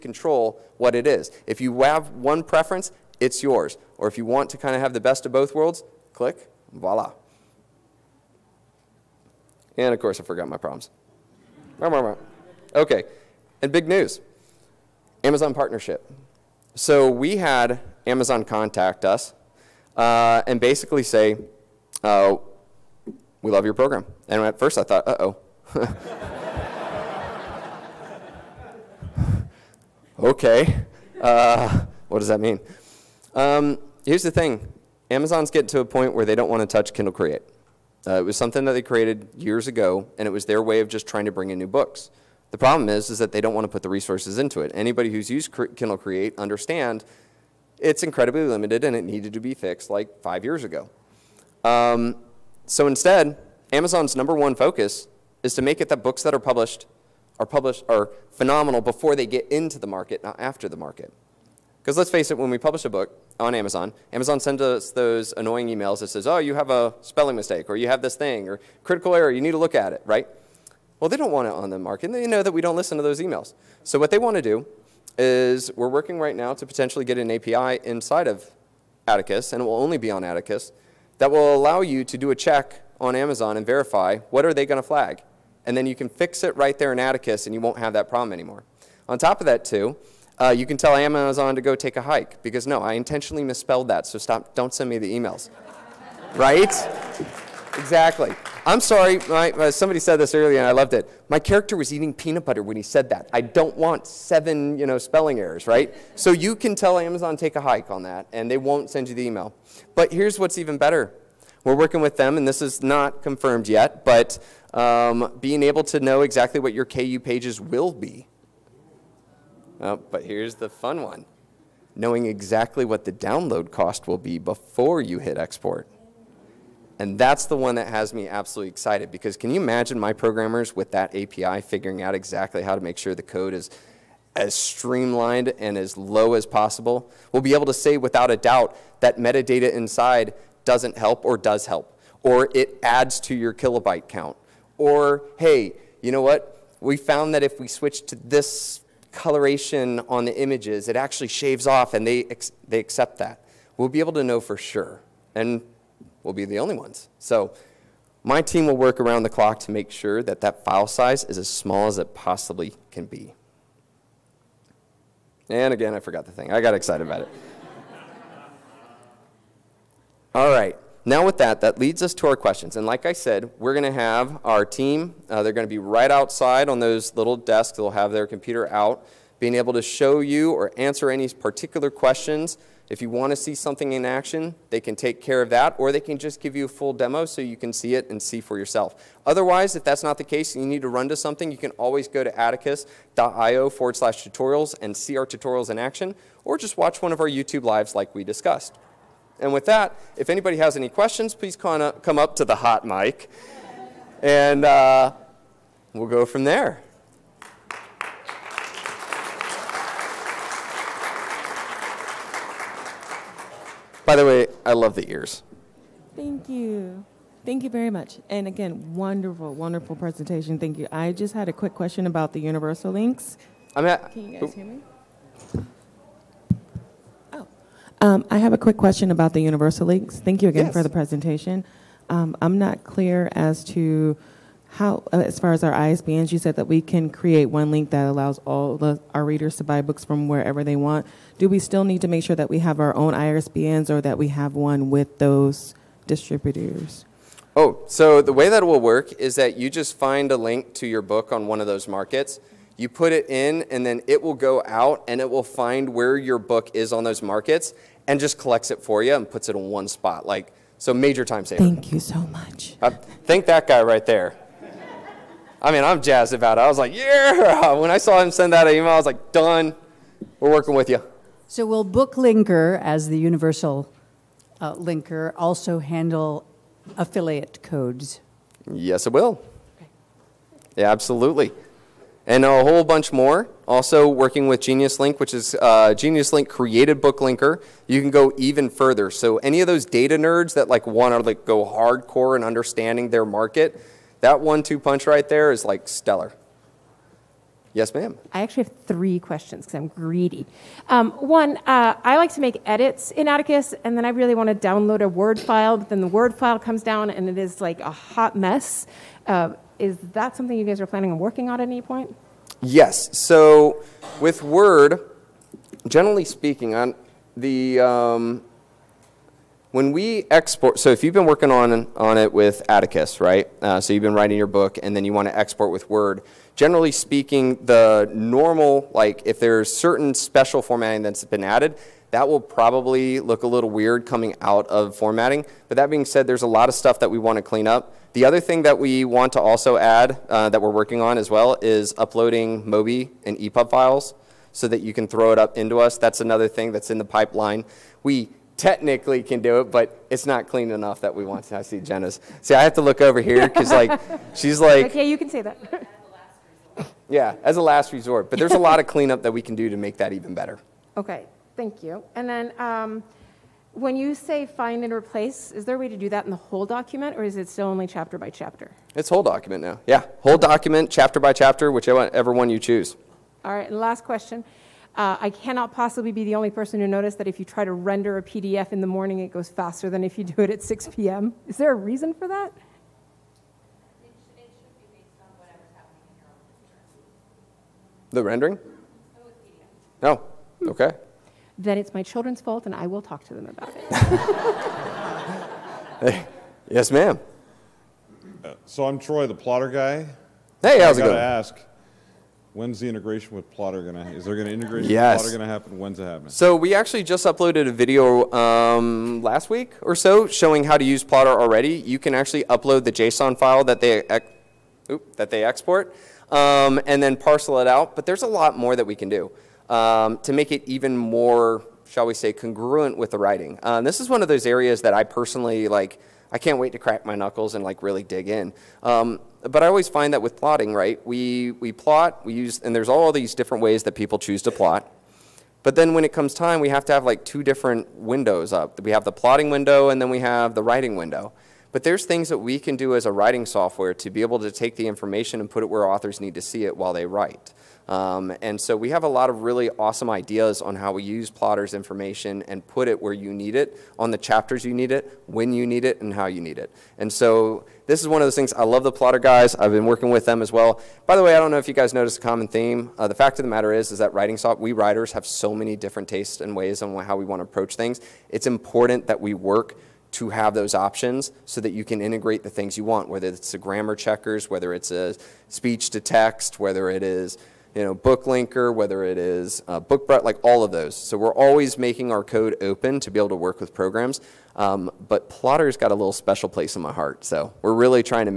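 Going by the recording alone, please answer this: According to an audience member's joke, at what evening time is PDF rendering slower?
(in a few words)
6 p.m.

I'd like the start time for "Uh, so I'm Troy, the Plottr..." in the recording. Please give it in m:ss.
6:38.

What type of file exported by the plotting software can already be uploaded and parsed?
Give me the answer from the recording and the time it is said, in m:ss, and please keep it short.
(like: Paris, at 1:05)
JSON file, at 6:52.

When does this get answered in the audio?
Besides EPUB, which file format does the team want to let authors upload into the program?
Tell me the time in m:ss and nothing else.
5:42.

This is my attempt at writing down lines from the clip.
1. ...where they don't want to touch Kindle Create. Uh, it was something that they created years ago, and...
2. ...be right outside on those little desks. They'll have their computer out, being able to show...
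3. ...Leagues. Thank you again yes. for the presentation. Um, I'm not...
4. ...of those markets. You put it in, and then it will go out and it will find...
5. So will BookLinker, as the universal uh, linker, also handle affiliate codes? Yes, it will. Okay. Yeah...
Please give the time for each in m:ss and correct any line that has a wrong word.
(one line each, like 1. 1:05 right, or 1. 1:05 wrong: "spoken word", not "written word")
1. 0:36 right
2. 2:55 right
3. 3:49 right
4. 4:11 right
5. 4:31 right.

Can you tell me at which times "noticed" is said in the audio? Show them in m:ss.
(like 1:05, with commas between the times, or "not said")
6:16, 7:41.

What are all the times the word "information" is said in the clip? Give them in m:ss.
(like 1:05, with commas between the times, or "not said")
7:24, 7:31.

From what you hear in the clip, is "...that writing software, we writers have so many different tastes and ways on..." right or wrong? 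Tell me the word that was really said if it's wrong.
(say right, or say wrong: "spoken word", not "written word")
right.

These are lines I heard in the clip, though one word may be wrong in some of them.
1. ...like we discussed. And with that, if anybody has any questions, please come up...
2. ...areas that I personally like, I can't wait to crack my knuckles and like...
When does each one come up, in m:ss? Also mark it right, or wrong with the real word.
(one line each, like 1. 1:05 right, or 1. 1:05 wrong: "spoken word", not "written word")
1. 3:17 right
2. 7:04 right.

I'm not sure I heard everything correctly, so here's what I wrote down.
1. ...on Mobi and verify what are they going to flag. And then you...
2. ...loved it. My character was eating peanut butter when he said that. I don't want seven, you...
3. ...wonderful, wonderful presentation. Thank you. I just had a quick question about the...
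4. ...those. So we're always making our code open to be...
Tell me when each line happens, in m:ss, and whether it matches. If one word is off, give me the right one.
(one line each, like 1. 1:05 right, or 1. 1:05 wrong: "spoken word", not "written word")
1. 1:22 wrong: "Amazon", not "Mobi"
2. 1:40 right
3. 3:38 right
4. 8:00 right.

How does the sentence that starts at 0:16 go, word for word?
So we had Amazon contact us uh, and basically say, uh, we love your program.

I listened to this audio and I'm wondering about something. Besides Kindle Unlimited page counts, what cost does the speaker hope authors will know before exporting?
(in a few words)
download cost.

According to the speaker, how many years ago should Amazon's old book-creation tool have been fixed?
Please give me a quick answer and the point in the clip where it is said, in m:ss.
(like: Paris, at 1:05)
5 years, at 0:50.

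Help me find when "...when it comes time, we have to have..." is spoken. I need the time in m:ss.
7:15.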